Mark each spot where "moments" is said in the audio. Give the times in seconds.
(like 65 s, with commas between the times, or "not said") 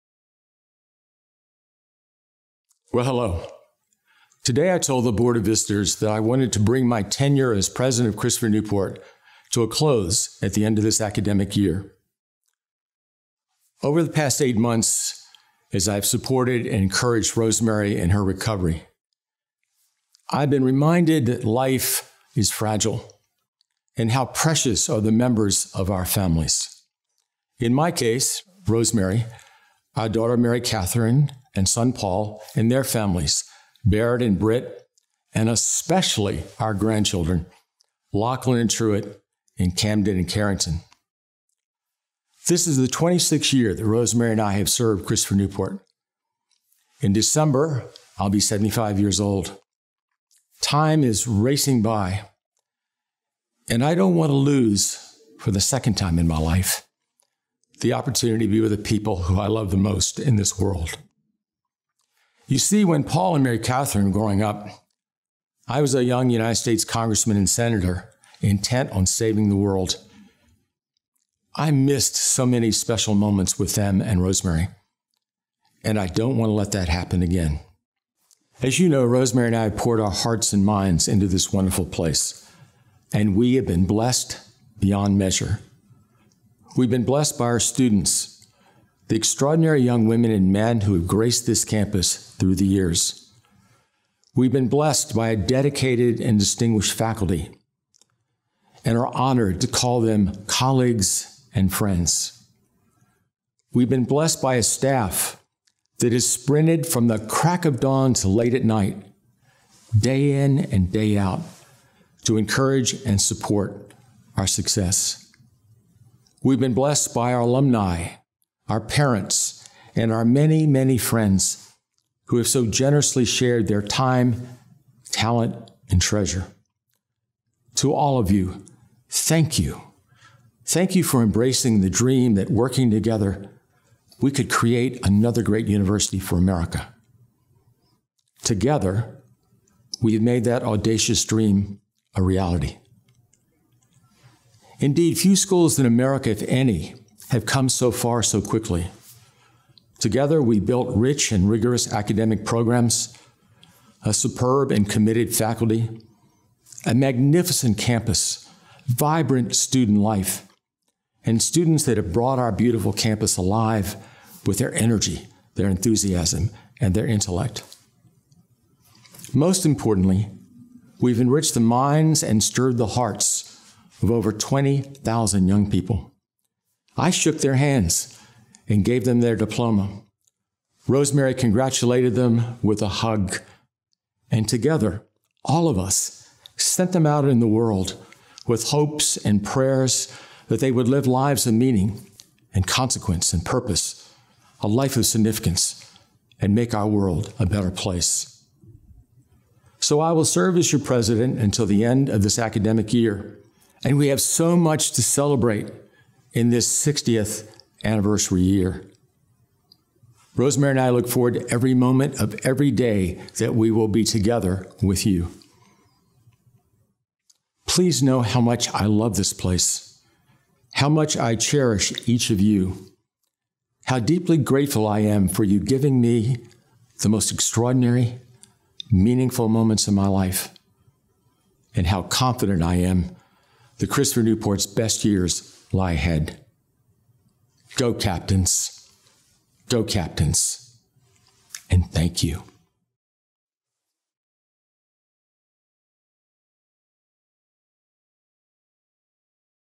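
73 s, 211 s, 229 s.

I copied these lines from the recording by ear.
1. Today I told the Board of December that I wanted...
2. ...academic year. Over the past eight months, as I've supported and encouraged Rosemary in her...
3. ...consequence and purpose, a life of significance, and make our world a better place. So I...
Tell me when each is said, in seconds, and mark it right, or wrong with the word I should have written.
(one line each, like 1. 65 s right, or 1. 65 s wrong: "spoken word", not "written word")
1. 4 s wrong: "Visitors", not "December"
2. 10 s right
3. 192 s right.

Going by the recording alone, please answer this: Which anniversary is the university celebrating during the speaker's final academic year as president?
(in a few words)
60th.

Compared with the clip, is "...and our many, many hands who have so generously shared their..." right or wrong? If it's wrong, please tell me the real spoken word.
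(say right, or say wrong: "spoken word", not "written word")
wrong: "friends", not "hands".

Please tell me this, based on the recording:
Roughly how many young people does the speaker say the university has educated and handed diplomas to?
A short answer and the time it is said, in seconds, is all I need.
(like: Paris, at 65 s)
Over 20,000, at 174 s.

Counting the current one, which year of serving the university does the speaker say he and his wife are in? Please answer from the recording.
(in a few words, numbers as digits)
26th.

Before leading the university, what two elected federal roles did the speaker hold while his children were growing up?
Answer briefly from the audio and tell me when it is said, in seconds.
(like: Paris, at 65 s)
Congressman and senator, at 66 s.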